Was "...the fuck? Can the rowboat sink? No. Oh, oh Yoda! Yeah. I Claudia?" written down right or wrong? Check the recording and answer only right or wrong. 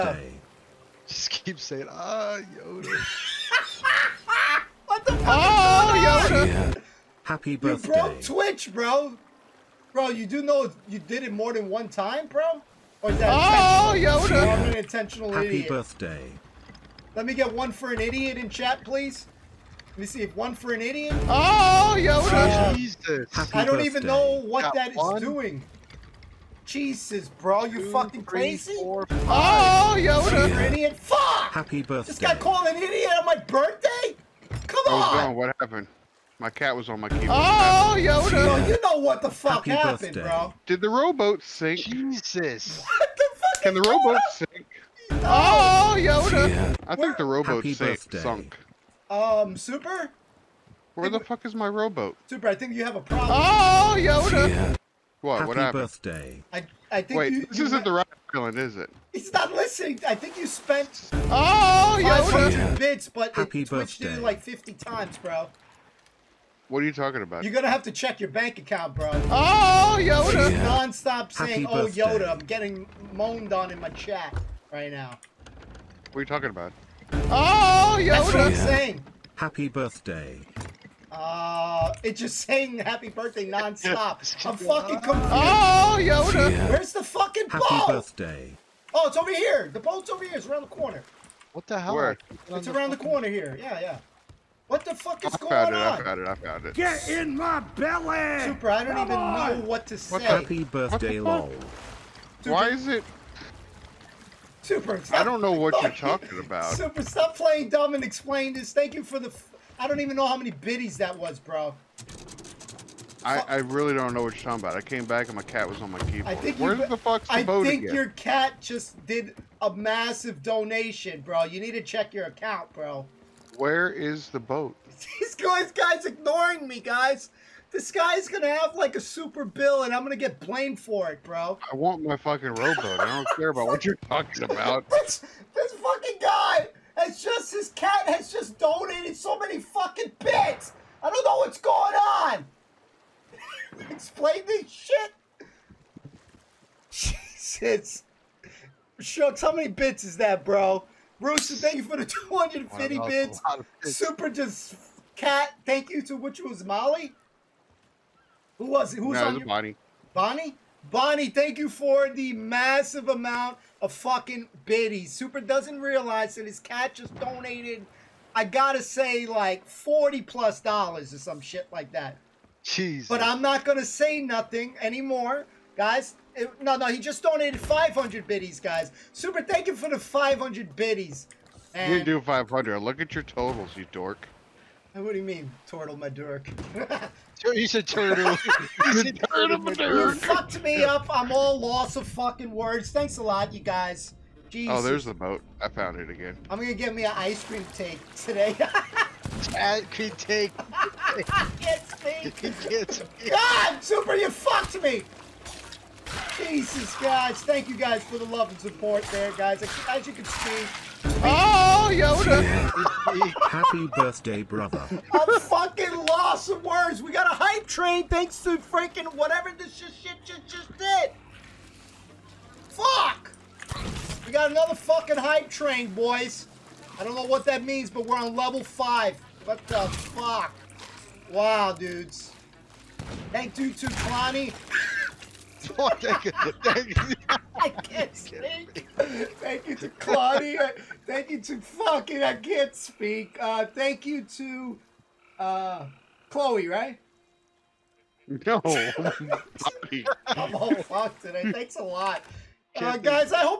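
wrong.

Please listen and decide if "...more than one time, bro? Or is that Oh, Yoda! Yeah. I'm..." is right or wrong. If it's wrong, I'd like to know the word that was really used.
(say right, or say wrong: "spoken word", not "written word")
right.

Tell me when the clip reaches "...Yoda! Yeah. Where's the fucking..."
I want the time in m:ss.
1:25.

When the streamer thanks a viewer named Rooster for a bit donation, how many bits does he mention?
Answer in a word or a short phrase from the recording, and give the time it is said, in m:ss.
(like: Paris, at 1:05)
250, at 2:32.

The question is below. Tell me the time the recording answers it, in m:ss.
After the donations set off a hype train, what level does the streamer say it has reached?
3:48.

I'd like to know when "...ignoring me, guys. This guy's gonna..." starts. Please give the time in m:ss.
2:06.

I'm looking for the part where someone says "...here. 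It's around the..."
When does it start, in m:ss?
1:30.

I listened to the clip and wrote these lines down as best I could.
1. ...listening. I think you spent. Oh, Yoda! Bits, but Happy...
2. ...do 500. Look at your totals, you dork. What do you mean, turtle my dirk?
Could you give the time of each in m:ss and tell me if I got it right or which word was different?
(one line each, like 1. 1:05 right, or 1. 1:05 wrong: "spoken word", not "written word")
1. 0:59 right
2. 3:02 right.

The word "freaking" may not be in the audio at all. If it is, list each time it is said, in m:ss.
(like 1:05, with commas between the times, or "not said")
3:38.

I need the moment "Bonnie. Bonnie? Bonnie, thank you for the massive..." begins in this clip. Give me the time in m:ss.
2:39.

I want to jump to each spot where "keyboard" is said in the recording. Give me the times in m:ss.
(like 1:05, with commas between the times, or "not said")
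0:37, 1:55.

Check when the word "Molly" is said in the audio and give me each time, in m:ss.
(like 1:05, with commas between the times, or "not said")
2:36.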